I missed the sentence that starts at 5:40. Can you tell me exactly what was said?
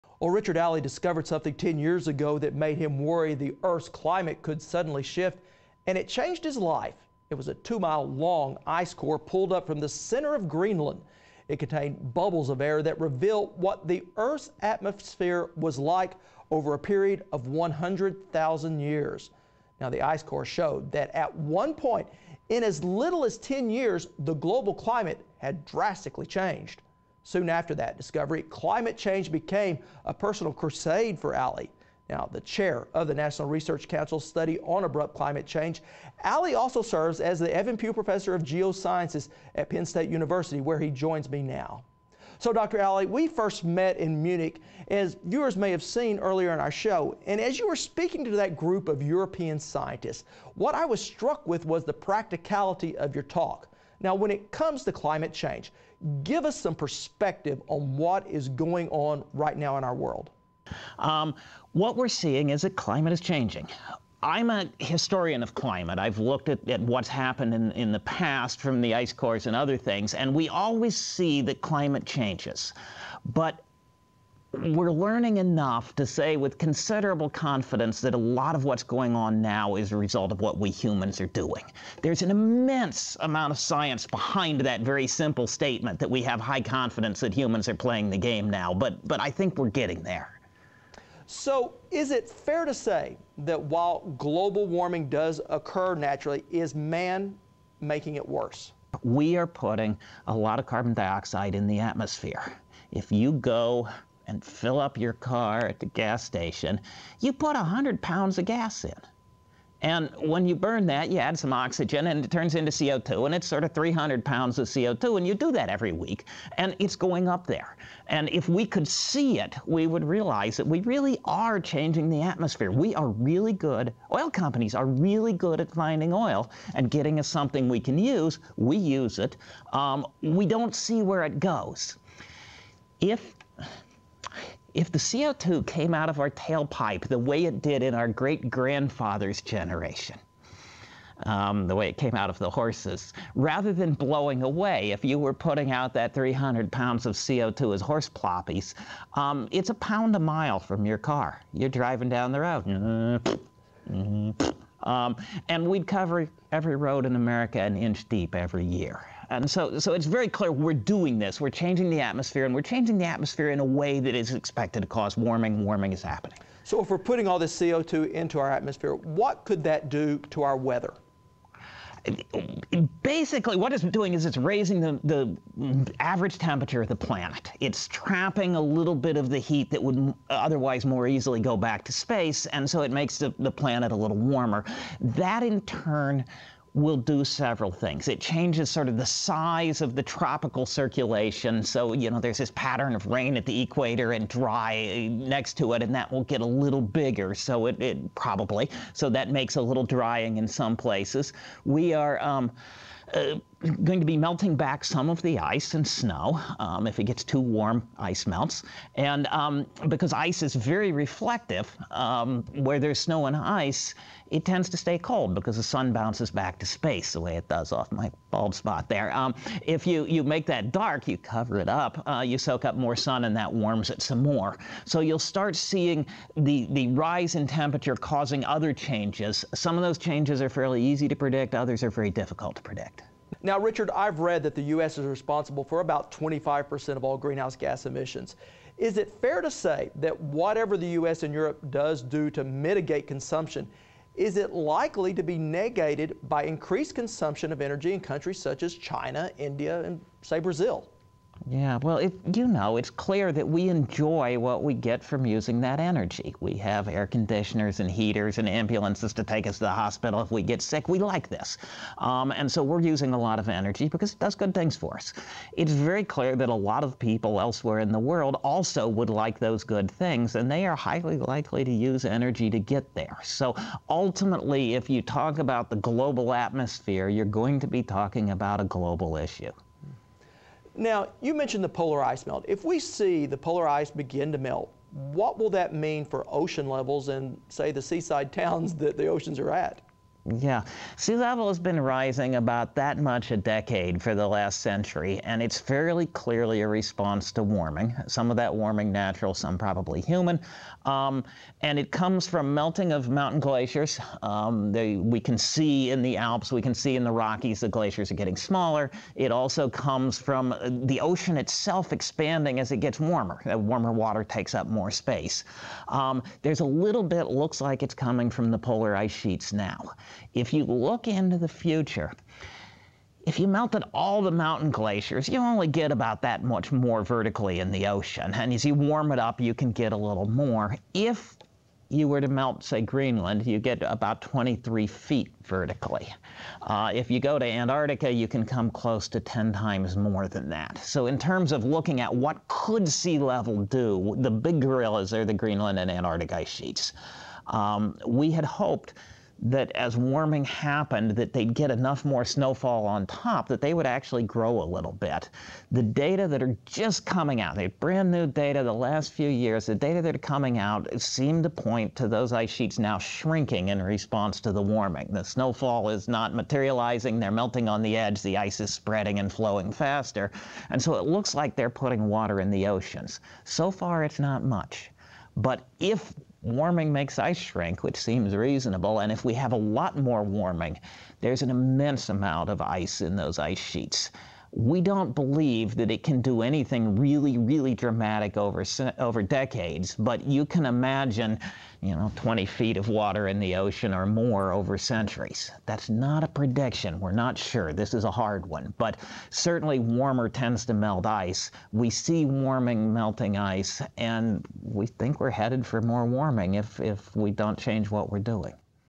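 So, in terms of looking at what could sea level do, the big gorillas are the Greenland and Antarctic ice sheets.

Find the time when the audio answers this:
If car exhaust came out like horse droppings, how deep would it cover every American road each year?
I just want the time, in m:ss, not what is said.
2:37.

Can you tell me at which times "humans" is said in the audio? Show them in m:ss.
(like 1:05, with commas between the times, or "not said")
1:20, 1:27, 4:59.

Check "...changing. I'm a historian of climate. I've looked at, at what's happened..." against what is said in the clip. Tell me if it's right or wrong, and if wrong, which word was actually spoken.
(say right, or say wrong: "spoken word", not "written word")
right.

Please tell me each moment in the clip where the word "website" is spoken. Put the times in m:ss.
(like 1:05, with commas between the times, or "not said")
not said.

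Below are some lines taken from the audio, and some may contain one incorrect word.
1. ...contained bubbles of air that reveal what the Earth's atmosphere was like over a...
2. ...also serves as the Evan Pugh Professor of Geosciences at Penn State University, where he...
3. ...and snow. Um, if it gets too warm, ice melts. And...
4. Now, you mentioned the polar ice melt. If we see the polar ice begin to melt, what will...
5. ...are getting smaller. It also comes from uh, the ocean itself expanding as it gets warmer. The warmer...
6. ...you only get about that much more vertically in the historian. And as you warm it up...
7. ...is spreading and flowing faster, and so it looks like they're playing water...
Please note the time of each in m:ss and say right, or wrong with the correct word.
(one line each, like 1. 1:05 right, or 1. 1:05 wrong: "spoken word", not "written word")
1. 0:11 right
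2. 0:36 right
3. 3:25 right
4. 4:40 right
5. 5:08 right
6. 5:25 wrong: "ocean", not "historian"
7. 6:08 wrong: "putting", not "playing".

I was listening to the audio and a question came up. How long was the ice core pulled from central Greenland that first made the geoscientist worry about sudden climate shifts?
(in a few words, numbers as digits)
2 miles.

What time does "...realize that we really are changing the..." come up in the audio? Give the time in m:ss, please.
2:00.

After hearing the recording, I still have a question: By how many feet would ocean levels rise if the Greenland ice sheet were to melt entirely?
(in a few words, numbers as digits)
23 feet.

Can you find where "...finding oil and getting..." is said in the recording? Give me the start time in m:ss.
2:05.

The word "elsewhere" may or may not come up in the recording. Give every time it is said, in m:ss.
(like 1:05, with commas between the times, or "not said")
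4:27.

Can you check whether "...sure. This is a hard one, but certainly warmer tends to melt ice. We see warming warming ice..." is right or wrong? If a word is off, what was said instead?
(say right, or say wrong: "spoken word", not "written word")
wrong: "melting", not "warming".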